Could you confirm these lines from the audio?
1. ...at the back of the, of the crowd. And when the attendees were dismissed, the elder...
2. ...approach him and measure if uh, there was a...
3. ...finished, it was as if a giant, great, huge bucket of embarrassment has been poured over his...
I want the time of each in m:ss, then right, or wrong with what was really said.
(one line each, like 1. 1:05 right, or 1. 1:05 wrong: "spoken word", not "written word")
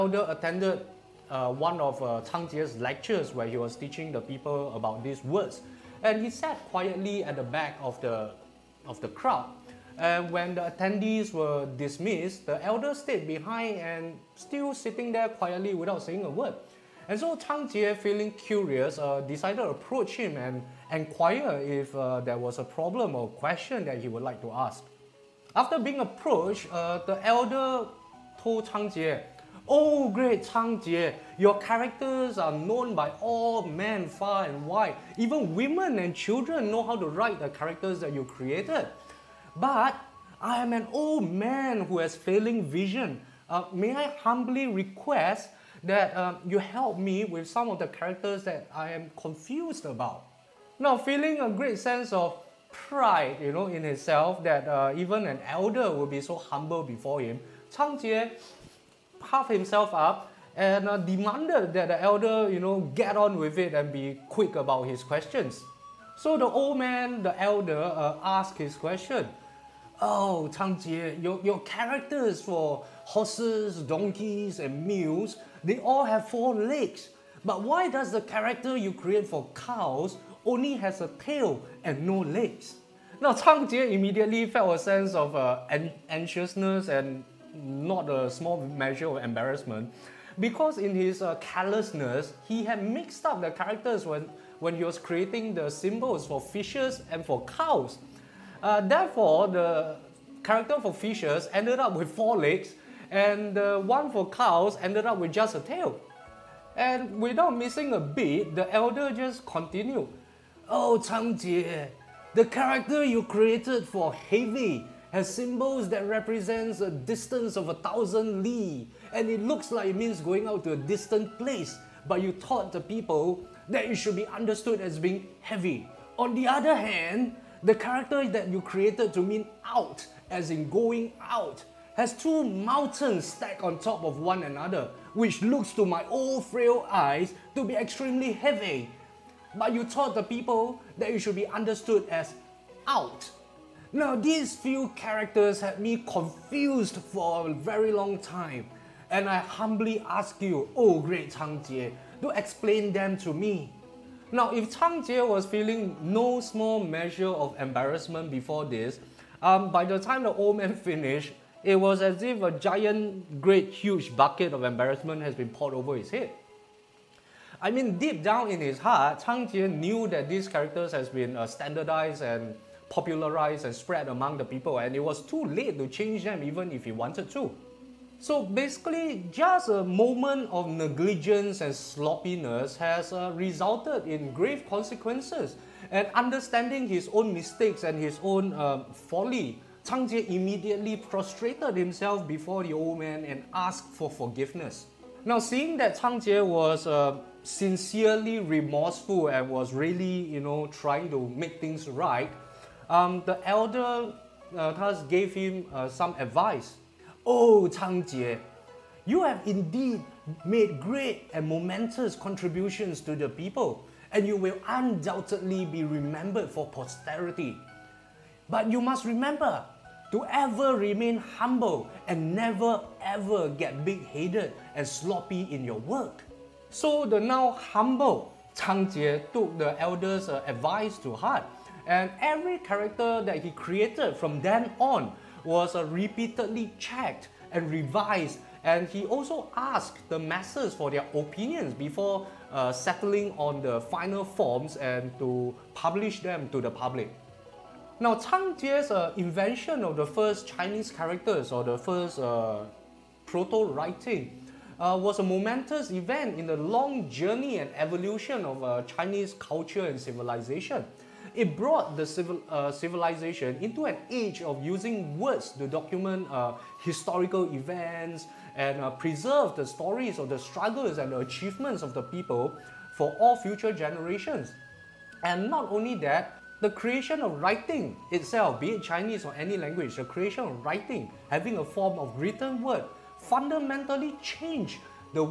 1. 0:07 right
2. 0:19 wrong: "inquire", not "measure"
3. 2:40 right.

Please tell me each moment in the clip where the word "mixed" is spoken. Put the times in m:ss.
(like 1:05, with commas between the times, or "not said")
1:32.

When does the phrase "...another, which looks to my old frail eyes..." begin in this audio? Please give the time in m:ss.
2:14.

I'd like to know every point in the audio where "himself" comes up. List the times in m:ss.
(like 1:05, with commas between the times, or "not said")
0:53, 0:59, 3:11.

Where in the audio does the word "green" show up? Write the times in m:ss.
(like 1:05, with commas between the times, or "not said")
not said.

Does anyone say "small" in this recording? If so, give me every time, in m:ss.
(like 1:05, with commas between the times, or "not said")
1:28, 2:36.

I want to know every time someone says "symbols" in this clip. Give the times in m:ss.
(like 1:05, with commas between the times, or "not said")
1:35, 1:55.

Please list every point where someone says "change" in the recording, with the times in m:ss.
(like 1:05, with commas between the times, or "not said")
2:55, 4:44.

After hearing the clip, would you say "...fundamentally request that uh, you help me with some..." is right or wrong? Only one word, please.
wrong.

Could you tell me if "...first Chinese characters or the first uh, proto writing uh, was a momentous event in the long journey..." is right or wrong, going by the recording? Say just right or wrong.
right.